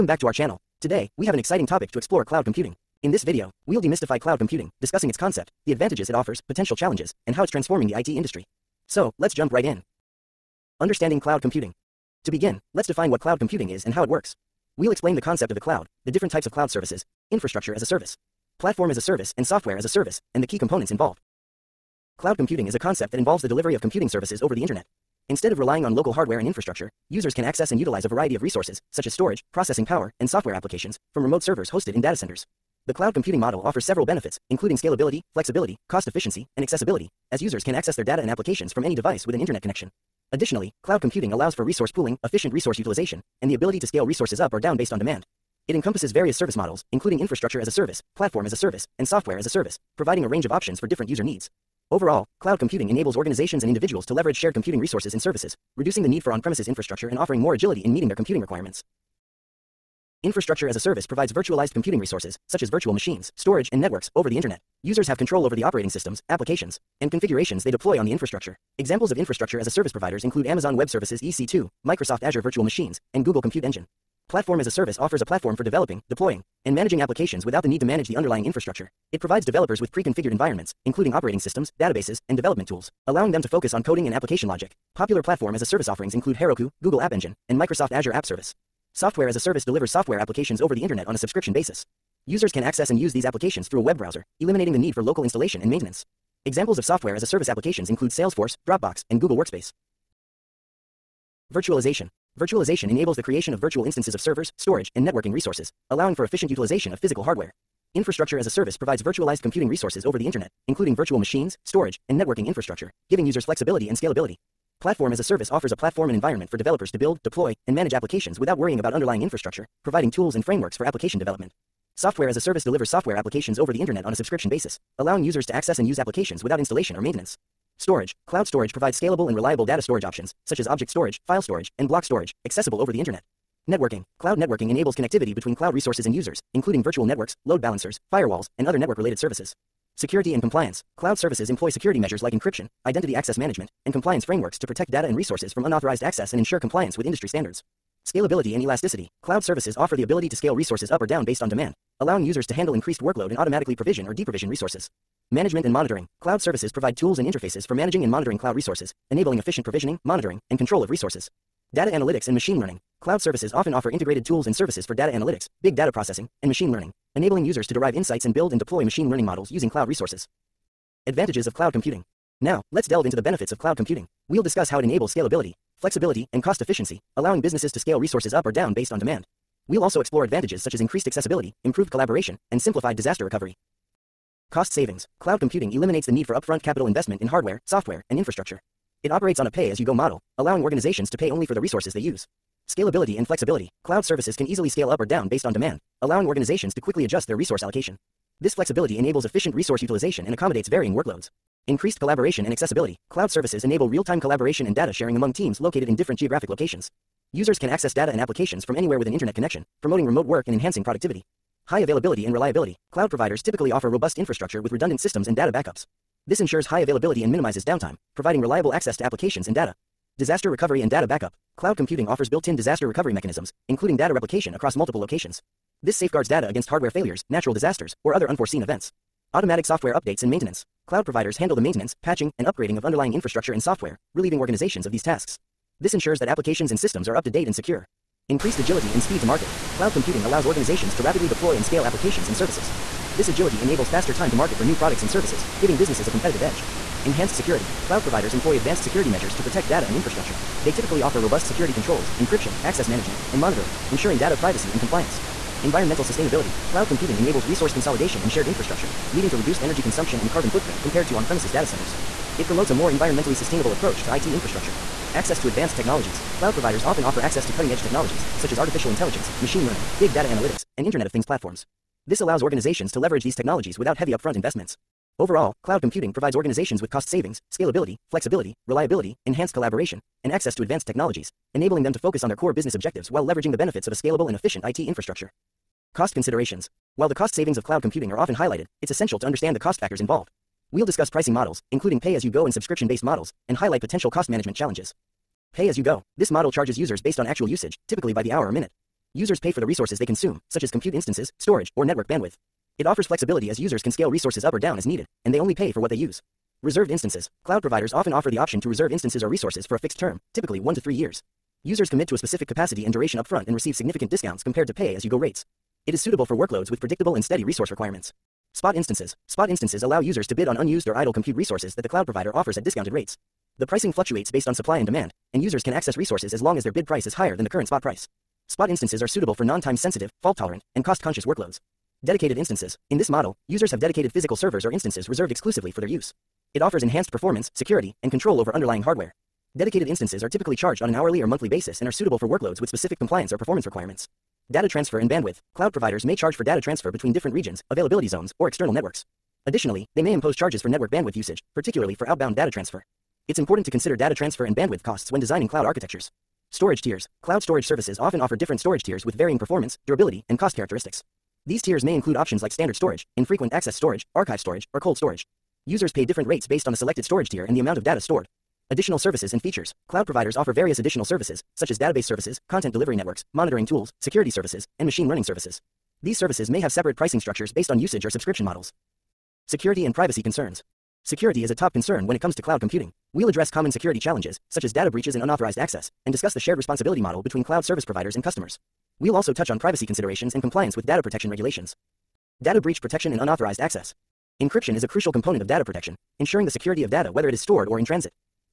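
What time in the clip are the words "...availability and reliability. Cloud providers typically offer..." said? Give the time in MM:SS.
03:31.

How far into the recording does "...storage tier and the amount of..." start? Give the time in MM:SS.
06:07.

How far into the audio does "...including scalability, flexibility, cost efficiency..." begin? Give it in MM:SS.
00:34.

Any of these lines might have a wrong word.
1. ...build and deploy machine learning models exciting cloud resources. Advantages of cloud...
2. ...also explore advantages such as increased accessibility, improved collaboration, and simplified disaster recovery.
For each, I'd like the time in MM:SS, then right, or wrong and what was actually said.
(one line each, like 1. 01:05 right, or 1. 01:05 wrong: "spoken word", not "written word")
1. 02:48 wrong: "using", not "exciting"
2. 02:59 right.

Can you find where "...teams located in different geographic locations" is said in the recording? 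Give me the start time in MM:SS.
03:25.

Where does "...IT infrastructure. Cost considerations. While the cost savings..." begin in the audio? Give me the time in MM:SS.
04:44.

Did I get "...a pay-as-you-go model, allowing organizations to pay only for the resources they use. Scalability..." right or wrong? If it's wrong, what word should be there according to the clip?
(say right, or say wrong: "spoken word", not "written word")
right.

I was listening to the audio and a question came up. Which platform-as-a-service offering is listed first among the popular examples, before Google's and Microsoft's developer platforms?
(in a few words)
Heroku.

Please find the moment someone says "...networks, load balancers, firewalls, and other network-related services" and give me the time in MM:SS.
02:17.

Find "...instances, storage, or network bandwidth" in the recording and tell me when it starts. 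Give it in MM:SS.
05:00.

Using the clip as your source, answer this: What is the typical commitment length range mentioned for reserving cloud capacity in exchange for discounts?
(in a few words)
1 to 3 years.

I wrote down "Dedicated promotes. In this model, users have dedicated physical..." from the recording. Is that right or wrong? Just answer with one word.
wrong.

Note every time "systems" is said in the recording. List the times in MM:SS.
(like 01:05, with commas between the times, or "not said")
01:05, 01:21, 03:34, 03:56.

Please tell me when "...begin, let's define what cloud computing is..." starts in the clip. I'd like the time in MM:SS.
00:12.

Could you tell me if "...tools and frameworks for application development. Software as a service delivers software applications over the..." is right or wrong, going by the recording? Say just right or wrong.
right.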